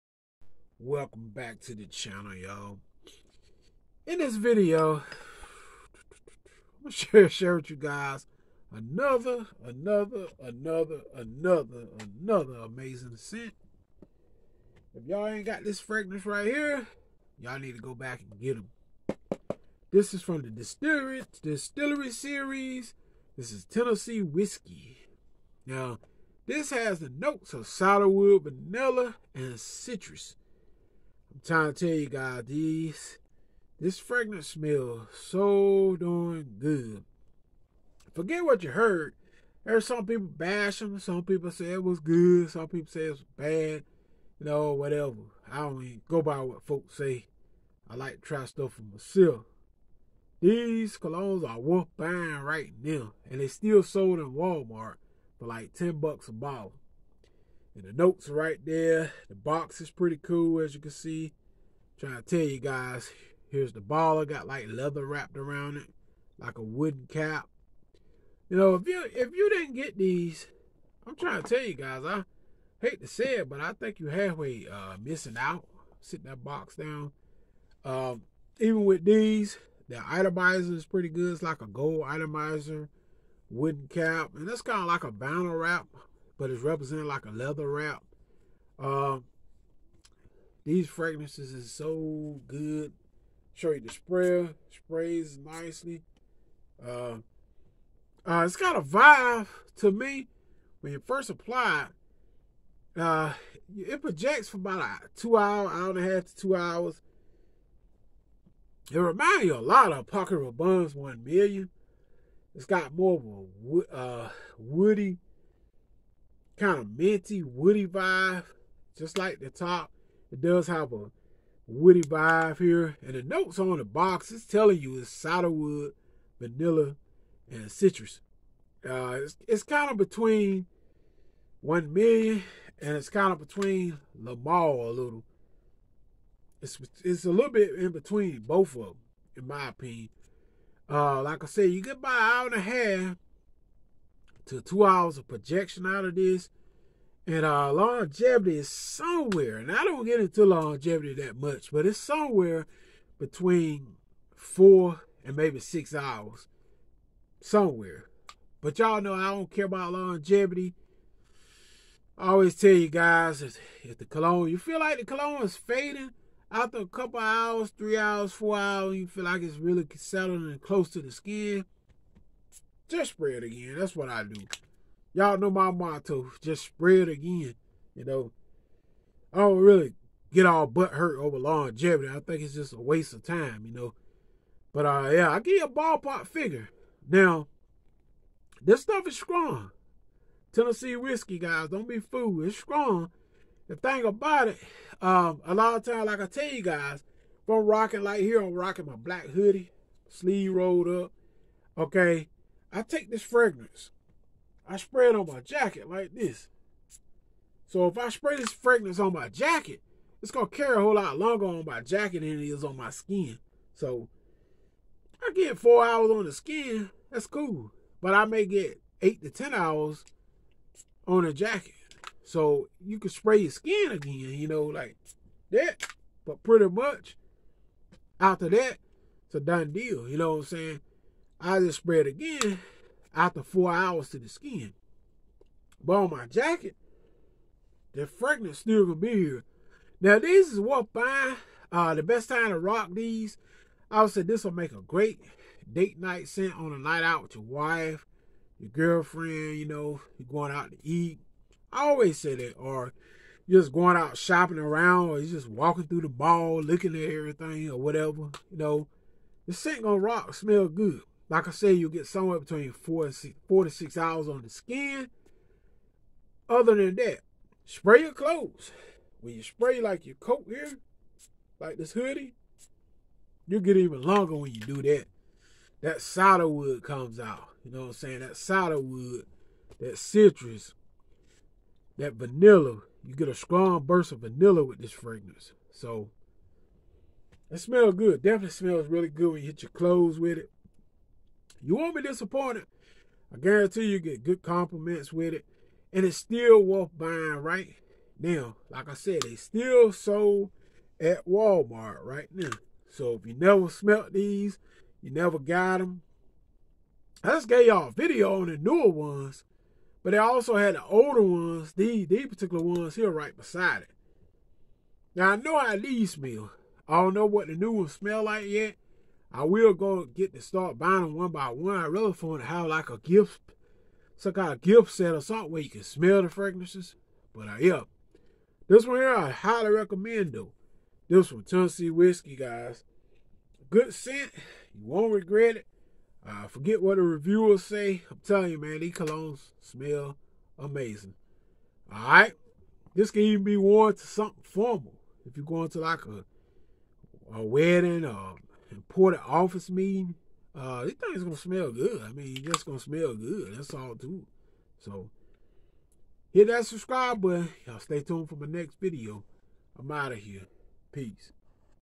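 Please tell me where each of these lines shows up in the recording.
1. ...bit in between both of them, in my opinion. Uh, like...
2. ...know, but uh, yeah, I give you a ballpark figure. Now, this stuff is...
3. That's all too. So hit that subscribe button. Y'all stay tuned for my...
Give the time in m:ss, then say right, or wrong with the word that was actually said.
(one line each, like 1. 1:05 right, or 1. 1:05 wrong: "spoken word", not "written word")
1. 2:17 right
2. 3:03 right
3. 5:53 right.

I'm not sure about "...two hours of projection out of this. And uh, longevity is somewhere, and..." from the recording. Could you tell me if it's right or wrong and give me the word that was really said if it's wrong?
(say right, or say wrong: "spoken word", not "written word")
right.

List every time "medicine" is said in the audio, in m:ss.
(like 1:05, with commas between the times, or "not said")
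not said.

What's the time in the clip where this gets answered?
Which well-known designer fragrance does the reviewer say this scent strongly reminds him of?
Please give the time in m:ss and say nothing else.
1:50.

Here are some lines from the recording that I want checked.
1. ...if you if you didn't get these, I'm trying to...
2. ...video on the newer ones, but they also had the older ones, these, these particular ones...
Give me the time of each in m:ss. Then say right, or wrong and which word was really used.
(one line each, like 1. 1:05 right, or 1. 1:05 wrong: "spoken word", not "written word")
1. 1:08 right
2. 5:07 right.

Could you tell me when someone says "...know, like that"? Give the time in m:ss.
3:44.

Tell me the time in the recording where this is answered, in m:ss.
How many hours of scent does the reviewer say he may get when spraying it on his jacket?
3:39.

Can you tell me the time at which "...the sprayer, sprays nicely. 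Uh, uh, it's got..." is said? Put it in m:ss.
1:33.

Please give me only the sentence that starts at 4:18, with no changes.
You know, the scent gonna rock, smell good.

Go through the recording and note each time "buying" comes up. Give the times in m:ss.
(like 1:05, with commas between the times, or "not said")
0:51, 4:56, 5:20.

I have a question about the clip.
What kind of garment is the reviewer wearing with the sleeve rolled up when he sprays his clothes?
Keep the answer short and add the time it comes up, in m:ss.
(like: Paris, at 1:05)
Black hoodie, at 3:18.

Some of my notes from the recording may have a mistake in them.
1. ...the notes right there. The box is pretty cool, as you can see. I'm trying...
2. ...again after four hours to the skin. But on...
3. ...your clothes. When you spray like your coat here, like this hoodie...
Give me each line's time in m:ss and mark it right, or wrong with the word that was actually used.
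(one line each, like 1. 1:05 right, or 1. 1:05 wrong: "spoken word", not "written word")
1. 0:57 right
2. 3:52 right
3. 4:28 right.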